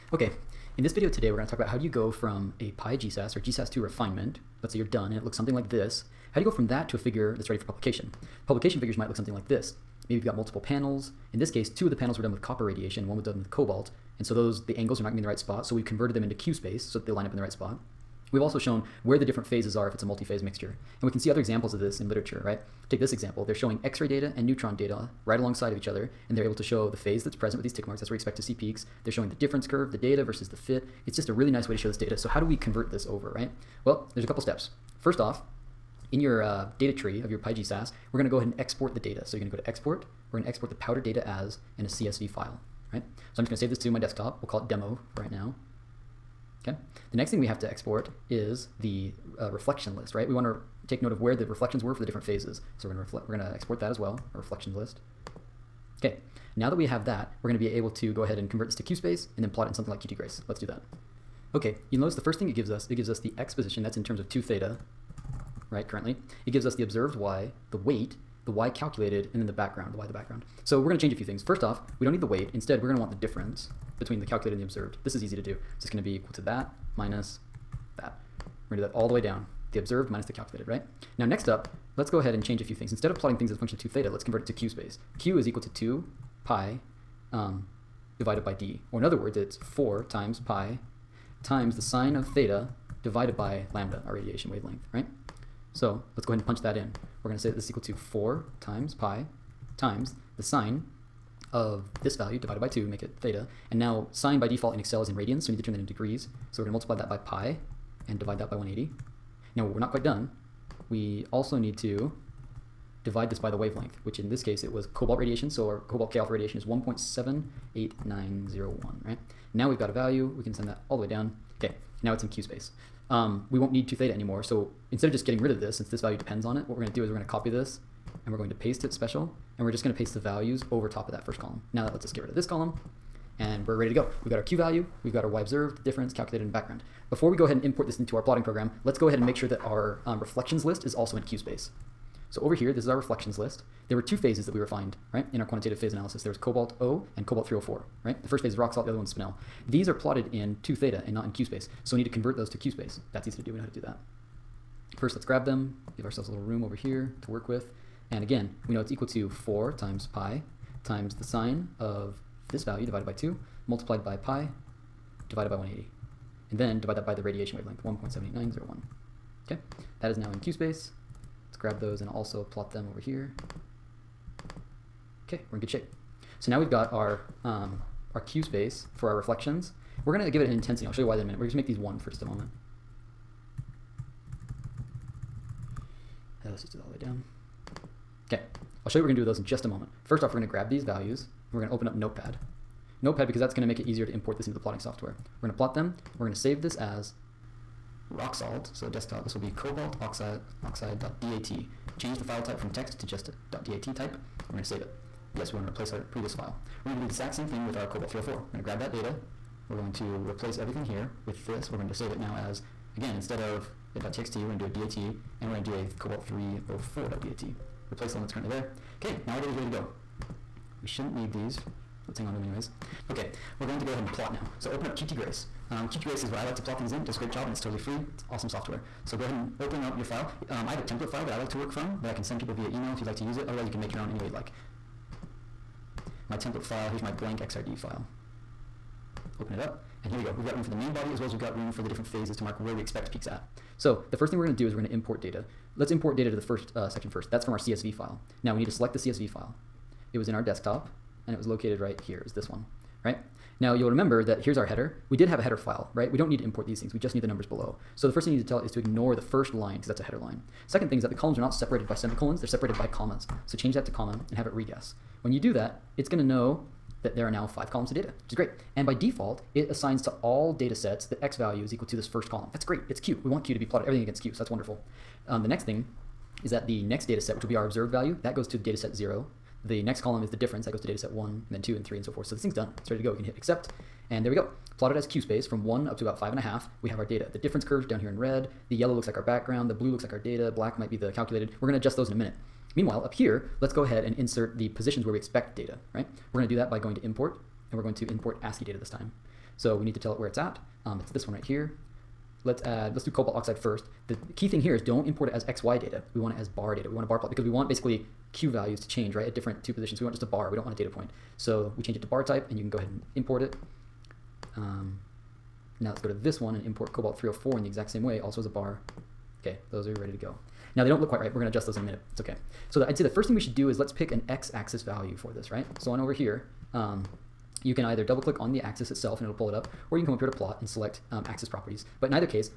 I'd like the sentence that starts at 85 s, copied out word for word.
q is equal to 2 pi um, divided by d.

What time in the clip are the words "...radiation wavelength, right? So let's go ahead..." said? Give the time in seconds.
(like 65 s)
94 s.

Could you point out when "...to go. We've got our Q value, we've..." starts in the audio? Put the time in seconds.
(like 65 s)
133 s.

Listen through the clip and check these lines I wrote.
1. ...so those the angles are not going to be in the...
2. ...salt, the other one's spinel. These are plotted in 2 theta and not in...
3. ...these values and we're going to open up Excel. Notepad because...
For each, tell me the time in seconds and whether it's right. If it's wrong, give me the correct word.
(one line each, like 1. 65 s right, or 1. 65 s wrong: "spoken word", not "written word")
1. 14 s right
2. 148 s right
3. 190 s wrong: "Notepad", not "Excel".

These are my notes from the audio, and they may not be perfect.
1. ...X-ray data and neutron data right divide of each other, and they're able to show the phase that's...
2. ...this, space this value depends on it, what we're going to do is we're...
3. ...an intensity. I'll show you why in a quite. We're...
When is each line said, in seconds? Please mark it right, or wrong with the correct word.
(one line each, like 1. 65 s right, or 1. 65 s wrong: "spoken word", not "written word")
1. 23 s wrong: "alongside", not "divide"
2. 125 s wrong: "since", not "space"
3. 180 s wrong: "minute", not "quite".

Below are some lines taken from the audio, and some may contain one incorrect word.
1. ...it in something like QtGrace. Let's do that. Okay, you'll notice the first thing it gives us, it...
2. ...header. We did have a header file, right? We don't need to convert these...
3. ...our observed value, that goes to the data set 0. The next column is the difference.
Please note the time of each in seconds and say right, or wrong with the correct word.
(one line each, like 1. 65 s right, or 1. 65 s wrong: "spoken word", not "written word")
1. 59 s right
2. 254 s wrong: "import", not "convert"
3. 277 s right.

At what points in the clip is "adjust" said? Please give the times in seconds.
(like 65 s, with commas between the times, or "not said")
291 s, 321 s.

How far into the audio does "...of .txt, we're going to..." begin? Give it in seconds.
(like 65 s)
213 s.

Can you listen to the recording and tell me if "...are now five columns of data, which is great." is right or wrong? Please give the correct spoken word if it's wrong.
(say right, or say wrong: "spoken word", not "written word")
right.